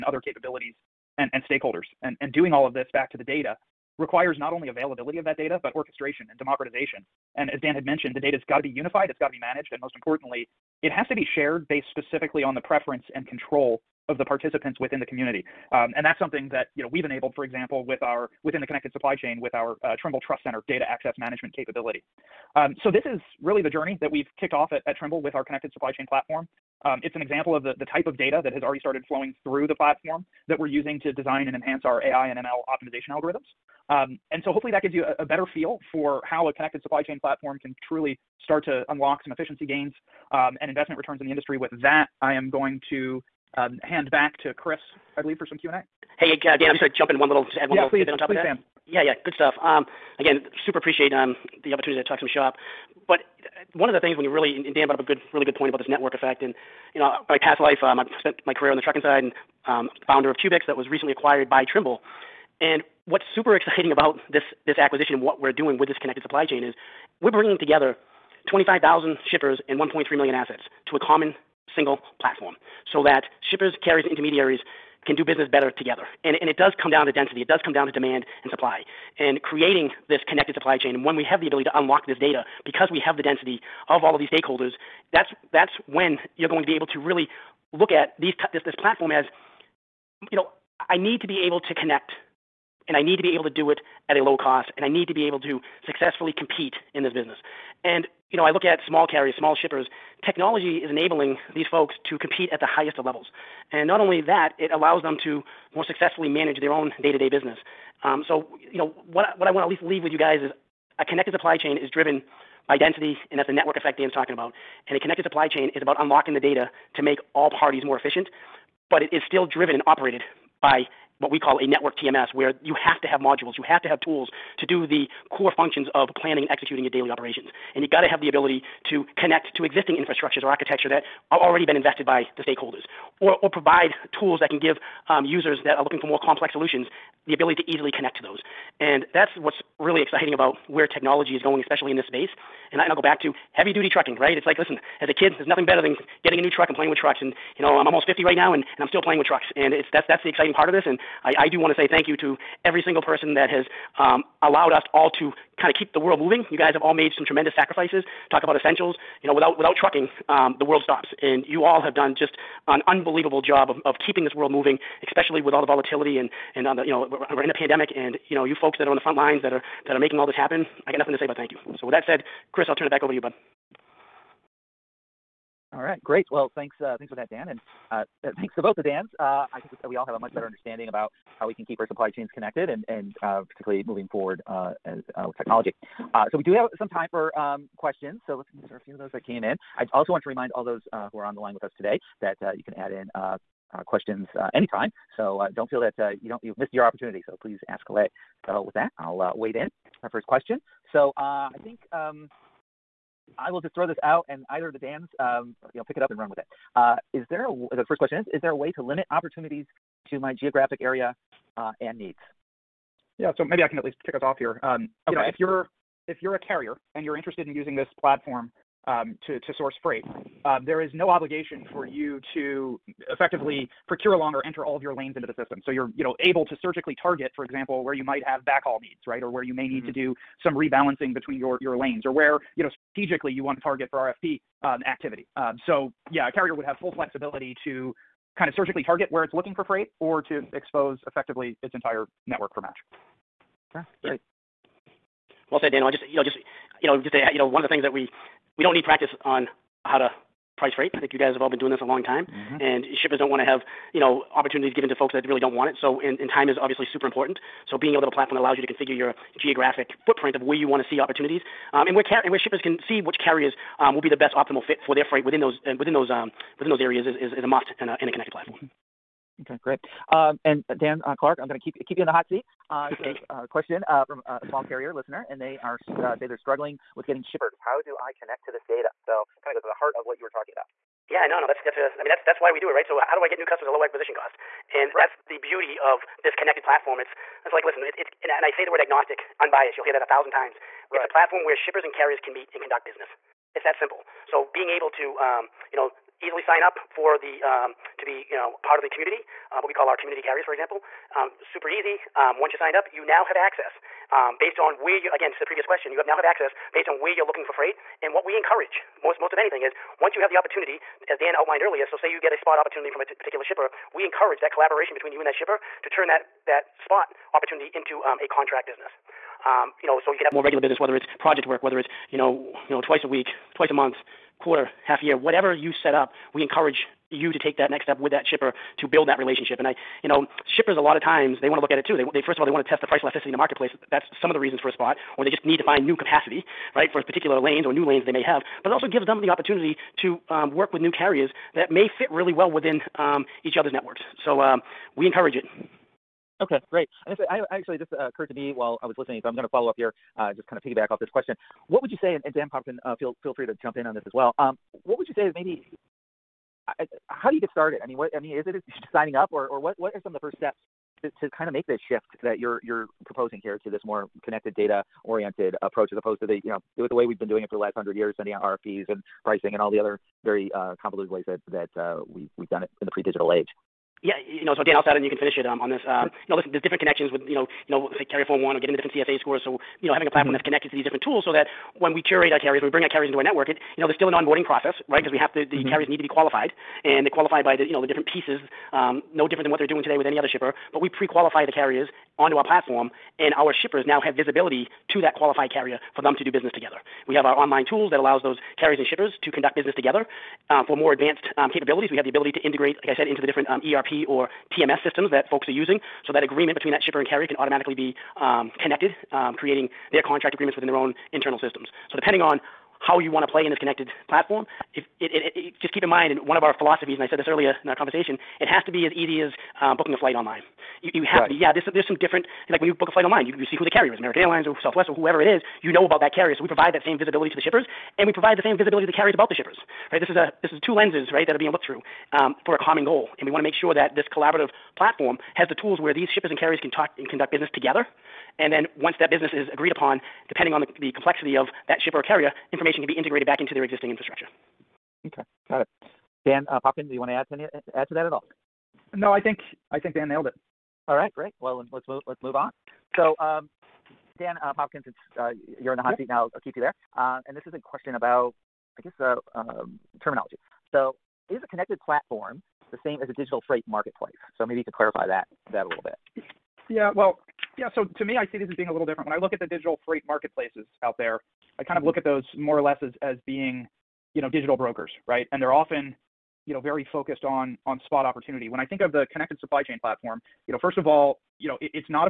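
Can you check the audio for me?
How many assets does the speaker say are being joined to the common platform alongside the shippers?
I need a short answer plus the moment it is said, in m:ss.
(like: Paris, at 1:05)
1.3 million, at 1:09.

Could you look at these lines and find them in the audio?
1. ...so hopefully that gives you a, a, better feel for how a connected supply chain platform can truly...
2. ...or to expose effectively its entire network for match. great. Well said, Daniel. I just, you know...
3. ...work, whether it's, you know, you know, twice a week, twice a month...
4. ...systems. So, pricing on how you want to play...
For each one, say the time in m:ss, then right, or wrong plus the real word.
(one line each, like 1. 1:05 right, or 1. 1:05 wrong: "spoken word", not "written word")
1. 0:34 right
2. 3:59 right
3. 5:21 right
4. 6:51 wrong: "depending", not "pricing".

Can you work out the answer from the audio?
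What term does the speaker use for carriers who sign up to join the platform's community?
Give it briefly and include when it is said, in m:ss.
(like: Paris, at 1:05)
Community carriers, at 4:59.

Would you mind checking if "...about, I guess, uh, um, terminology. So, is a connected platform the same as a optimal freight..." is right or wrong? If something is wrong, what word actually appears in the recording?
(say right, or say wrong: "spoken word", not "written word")
wrong: "digital", not "optimal".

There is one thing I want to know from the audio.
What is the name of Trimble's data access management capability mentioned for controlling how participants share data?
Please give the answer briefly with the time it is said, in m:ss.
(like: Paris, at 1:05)
Trimble Trust Center, at 0:20.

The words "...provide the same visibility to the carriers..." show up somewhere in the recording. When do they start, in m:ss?
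7:08.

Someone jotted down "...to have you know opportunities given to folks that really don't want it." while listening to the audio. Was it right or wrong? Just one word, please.
right.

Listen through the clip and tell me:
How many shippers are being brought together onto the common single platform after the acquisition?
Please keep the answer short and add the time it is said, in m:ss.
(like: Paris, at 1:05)
25,000, at 1:08.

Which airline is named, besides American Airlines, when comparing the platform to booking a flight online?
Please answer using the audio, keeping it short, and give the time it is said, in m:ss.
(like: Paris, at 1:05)
Southwest, at 7:04.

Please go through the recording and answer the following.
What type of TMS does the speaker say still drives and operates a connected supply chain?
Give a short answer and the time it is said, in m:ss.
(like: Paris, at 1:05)
Network TMS, at 2:01.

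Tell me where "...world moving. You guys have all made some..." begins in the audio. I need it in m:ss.
2:35.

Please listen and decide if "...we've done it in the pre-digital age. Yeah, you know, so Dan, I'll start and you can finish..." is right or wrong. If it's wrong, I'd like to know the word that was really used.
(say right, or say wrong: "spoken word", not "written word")
right.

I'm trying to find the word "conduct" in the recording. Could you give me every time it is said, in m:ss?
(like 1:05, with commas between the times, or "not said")
4:52, 6:39, 7:17.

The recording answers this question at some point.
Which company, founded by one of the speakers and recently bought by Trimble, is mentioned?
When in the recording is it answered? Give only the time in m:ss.
1:00.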